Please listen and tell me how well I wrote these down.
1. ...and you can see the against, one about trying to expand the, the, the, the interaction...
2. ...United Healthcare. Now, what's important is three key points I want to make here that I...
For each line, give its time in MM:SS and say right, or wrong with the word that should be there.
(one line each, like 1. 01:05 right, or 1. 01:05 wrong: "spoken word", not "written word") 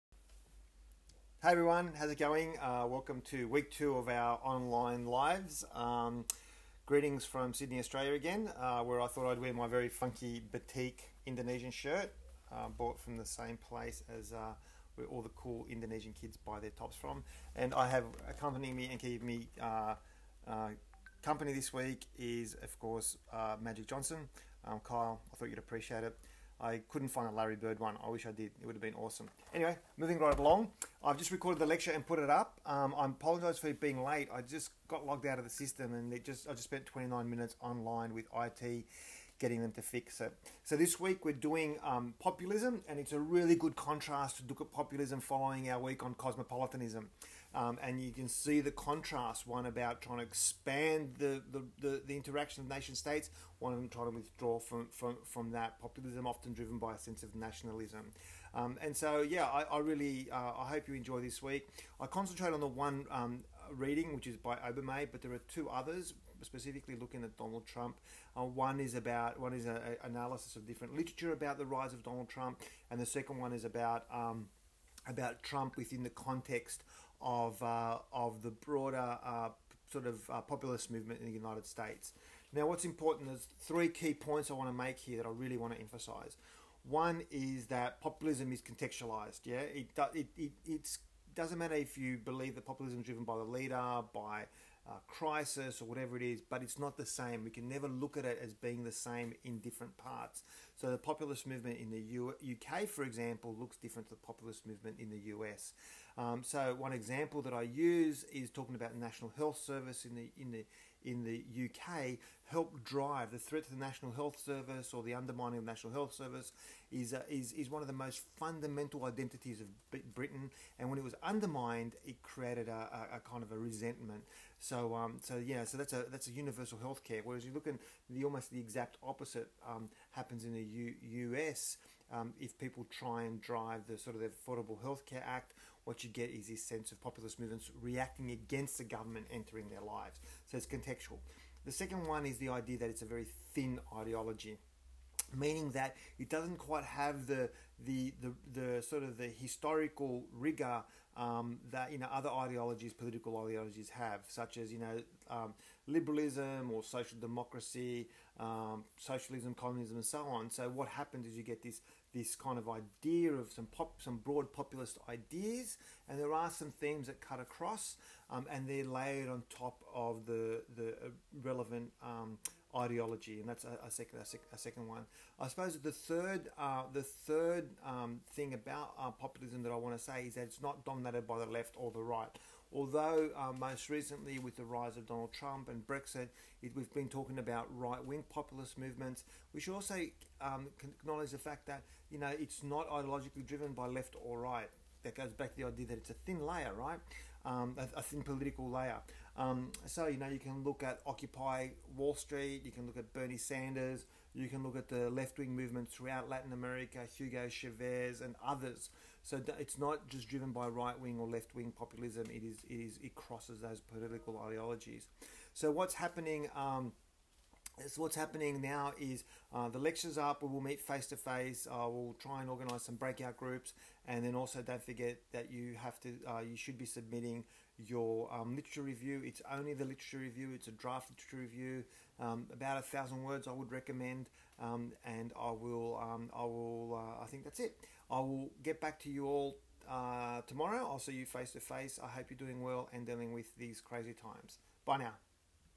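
1. 00:47 wrong: "contrast", not "against"
2. 01:21 wrong: "States", not "Healthcare".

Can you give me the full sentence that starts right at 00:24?
Um, Kyle, I thought you'd appreciate it.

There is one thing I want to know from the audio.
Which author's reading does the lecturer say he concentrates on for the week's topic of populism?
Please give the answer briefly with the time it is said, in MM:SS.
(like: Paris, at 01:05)
Obermay, at 01:04.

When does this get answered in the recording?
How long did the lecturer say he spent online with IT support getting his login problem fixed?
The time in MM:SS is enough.
00:36.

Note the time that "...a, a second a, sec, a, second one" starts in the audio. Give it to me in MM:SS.
02:53.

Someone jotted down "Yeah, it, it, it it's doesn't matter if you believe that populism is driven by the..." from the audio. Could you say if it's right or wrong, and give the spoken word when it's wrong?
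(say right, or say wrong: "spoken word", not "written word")
right.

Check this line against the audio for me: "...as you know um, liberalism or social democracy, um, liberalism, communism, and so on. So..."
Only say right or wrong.
wrong.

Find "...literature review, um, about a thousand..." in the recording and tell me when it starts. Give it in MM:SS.
03:51.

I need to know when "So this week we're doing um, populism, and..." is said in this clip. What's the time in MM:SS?
00:40.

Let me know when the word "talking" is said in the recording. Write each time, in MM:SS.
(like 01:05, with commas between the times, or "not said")
01:48, 03:07.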